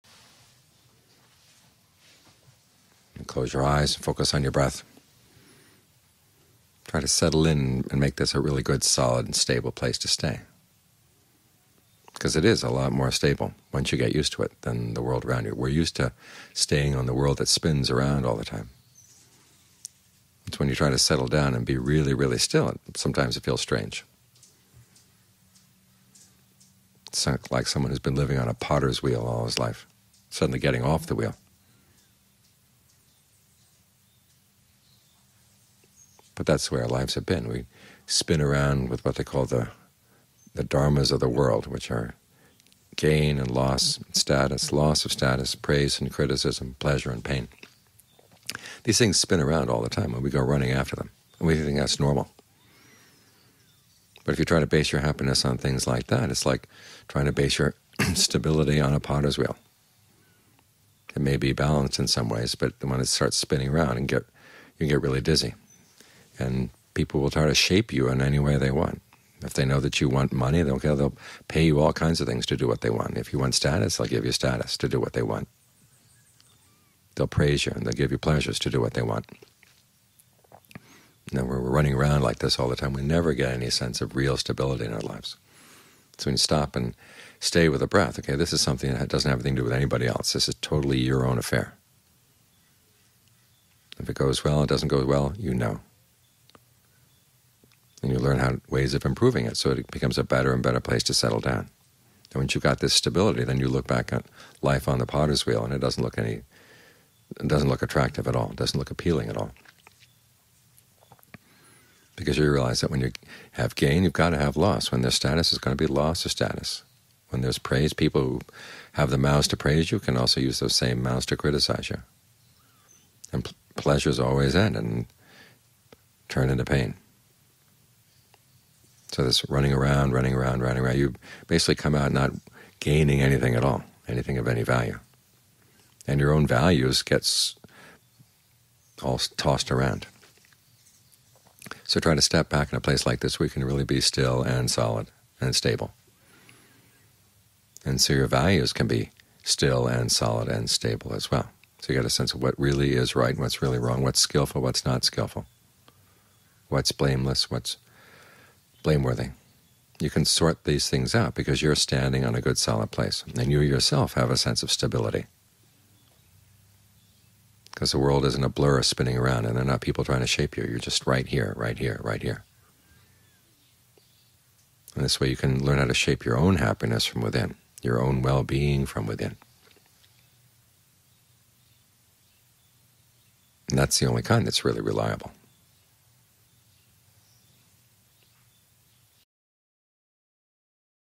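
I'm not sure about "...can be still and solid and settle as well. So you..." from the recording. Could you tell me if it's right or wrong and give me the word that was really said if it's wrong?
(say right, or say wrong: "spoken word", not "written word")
wrong: "stable", not "settle".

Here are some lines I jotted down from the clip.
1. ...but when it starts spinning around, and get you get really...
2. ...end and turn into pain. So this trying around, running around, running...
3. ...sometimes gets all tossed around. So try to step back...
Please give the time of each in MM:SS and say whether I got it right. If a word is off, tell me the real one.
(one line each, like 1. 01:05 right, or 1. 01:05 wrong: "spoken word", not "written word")
1. 01:02 right
2. 02:04 wrong: "running", not "trying"
3. 02:16 wrong: "values", not "sometimes".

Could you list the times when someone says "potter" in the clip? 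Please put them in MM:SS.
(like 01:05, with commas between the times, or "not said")
00:28, 00:58, 01:45.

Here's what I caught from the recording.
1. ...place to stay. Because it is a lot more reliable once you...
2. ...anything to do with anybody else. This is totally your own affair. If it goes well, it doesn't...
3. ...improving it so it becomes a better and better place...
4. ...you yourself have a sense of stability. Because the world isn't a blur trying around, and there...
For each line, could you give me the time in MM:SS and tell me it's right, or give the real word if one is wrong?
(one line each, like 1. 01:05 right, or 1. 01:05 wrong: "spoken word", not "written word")
1. 00:09 wrong: "stable", not "reliable"
2. 01:29 right
3. 01:39 right
4. 02:43 wrong: "spinning", not "trying".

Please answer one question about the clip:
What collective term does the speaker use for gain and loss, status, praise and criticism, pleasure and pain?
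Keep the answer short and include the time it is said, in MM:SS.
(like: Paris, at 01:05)
dharmas of the world, at 00:40.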